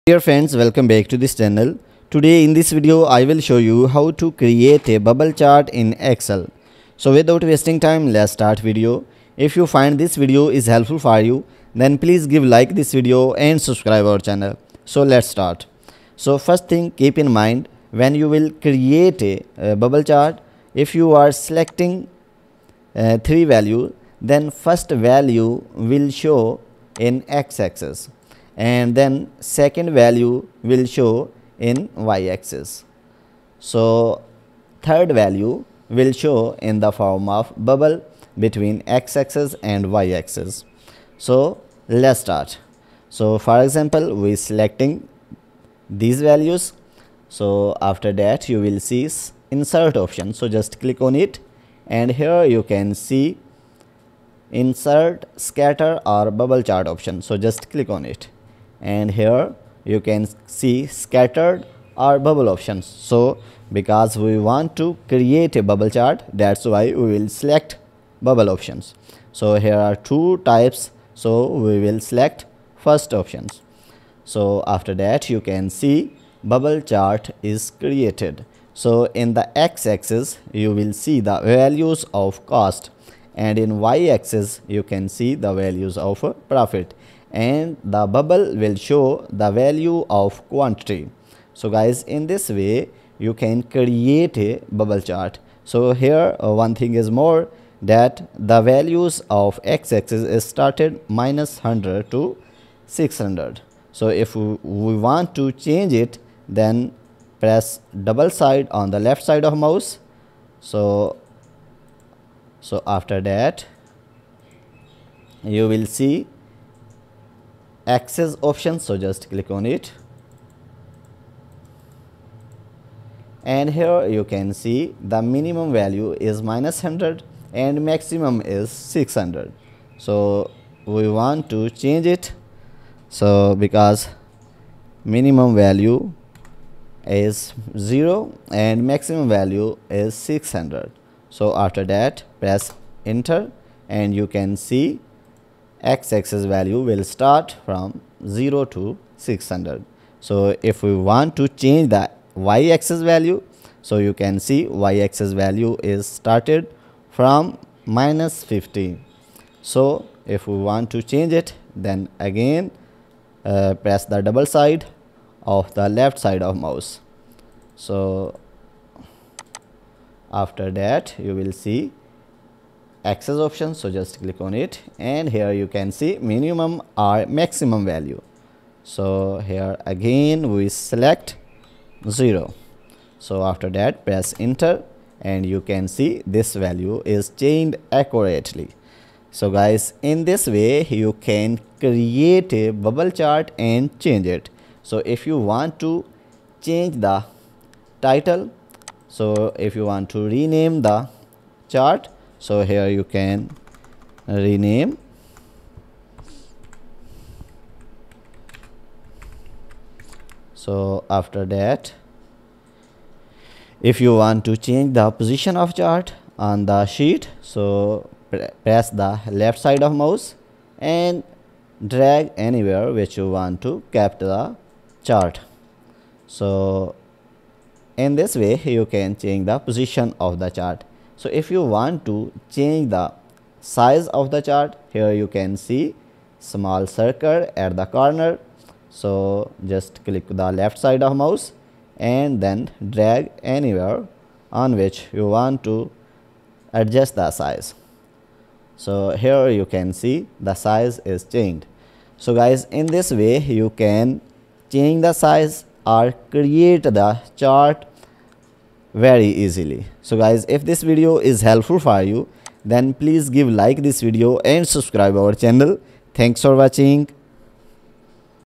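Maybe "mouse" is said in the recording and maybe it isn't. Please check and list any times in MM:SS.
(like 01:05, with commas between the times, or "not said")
01:49, 02:46, 03:39, 04:01.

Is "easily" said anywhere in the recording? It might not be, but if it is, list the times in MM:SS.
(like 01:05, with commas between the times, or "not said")
04:19.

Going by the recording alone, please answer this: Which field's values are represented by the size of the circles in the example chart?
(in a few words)
quantity.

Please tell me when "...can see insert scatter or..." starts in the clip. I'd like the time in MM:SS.
00:52.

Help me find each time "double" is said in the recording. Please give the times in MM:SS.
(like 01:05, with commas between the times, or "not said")
01:48, 02:44.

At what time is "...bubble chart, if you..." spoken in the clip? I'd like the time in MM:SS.
00:19.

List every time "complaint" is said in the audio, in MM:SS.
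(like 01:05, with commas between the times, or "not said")
not said.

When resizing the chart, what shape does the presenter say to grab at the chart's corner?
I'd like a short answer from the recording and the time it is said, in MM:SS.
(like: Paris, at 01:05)
small circle, at 03:56.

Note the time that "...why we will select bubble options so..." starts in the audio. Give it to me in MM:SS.
01:06.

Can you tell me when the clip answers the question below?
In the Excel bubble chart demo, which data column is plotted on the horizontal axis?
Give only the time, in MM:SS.
01:22.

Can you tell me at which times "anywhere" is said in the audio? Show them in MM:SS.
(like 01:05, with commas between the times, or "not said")
03:42, 04:03.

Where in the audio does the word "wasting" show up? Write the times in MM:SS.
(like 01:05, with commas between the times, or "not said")
00:07.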